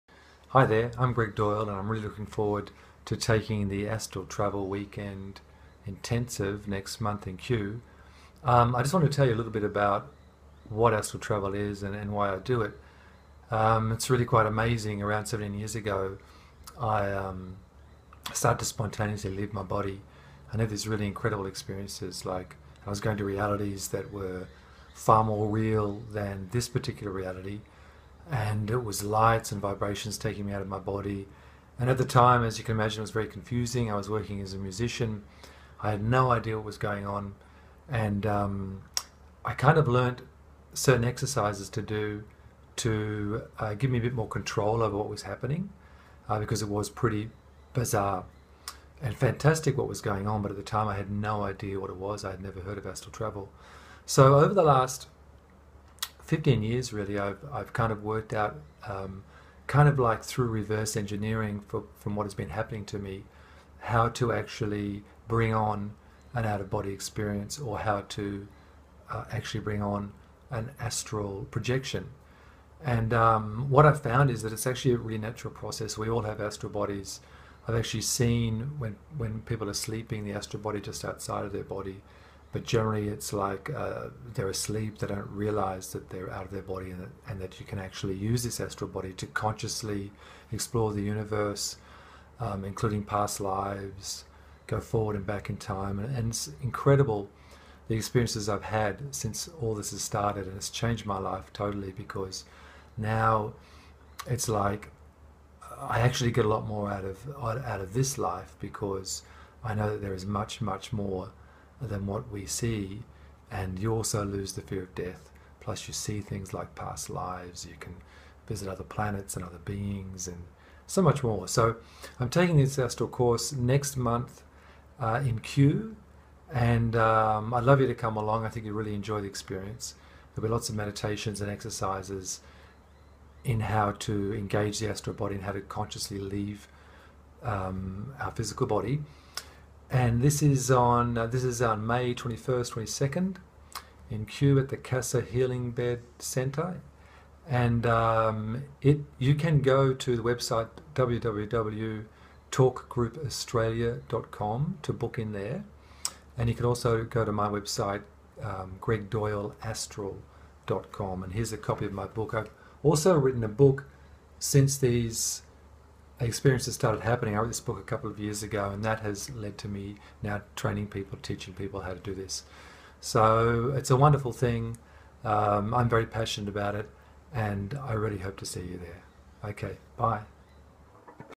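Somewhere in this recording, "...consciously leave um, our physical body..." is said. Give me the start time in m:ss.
2:15.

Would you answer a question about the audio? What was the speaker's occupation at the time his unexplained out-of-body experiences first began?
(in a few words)
Musician.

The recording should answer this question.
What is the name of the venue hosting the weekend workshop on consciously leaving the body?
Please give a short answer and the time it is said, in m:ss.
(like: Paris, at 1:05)
Casa Healing Bed Centre, at 2:24.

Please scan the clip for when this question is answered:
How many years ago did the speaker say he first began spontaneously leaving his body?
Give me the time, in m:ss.
0:15.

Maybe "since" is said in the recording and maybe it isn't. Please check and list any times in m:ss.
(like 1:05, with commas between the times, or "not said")
1:39, 2:44.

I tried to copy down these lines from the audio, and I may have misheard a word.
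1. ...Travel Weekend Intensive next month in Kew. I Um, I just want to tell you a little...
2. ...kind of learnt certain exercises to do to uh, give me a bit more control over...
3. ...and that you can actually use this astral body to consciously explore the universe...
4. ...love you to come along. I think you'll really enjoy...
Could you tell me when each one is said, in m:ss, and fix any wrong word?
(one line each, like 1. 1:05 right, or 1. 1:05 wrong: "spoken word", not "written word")
1. 0:04 right
2. 0:39 right
3. 1:27 right
4. 2:07 right.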